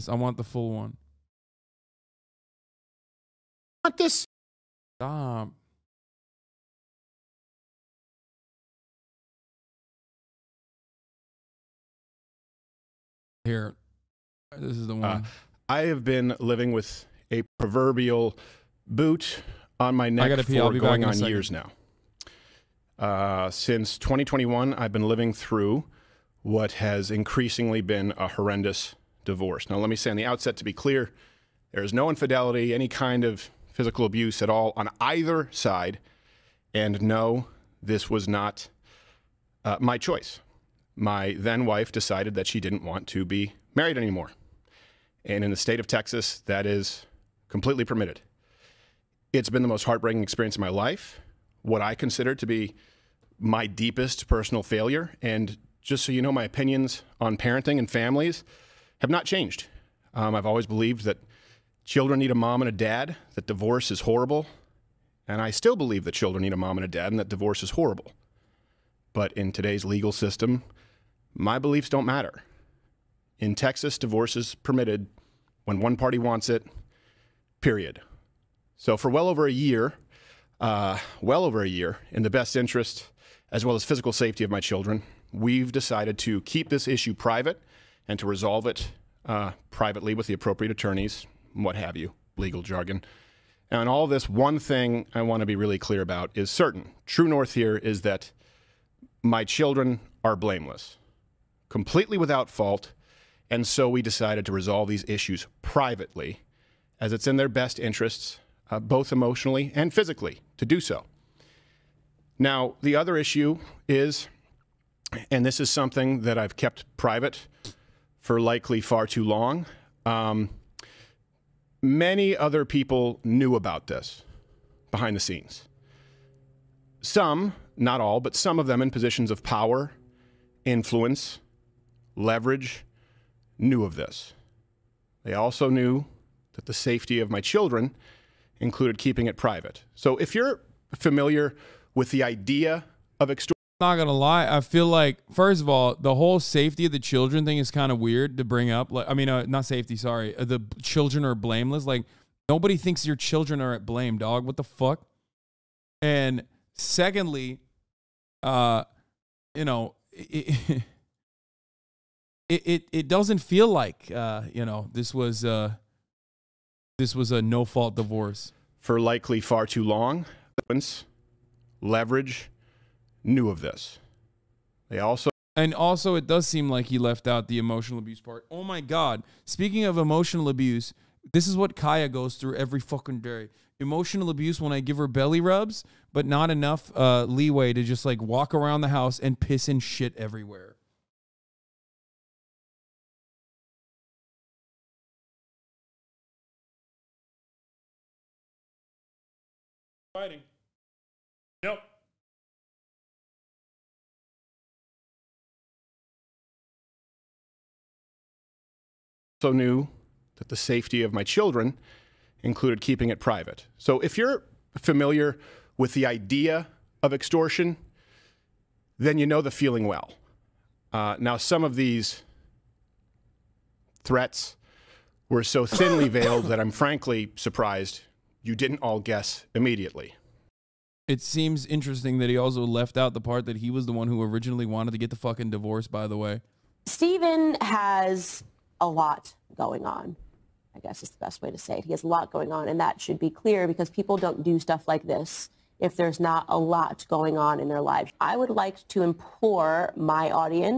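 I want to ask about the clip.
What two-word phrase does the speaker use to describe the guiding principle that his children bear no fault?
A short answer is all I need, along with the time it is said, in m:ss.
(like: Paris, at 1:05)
True North, at 1:37.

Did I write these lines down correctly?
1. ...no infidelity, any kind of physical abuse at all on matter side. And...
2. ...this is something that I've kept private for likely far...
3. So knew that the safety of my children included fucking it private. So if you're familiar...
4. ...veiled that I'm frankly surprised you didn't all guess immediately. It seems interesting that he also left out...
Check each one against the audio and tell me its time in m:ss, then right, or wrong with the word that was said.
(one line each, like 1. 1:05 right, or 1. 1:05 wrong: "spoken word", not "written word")
1. 0:31 wrong: "either", not "matter"
2. 1:55 right
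3. 3:29 wrong: "keeping", not "fucking"
4. 3:46 right.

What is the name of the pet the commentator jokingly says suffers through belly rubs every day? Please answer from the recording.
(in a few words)
Kaya.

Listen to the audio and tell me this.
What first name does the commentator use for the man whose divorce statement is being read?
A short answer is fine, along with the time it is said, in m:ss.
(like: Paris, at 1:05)
Steven, at 3:56.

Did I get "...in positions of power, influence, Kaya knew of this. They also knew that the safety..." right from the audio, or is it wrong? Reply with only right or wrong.
wrong.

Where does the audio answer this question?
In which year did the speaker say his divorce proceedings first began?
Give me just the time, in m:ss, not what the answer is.
0:23.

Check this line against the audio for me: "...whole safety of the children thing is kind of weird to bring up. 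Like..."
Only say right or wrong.
right.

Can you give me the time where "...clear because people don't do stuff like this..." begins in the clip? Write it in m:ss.
4:03.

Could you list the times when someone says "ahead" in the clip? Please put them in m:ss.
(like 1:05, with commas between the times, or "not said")
not said.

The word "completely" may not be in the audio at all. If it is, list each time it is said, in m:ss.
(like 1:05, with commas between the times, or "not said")
0:47, 1:41.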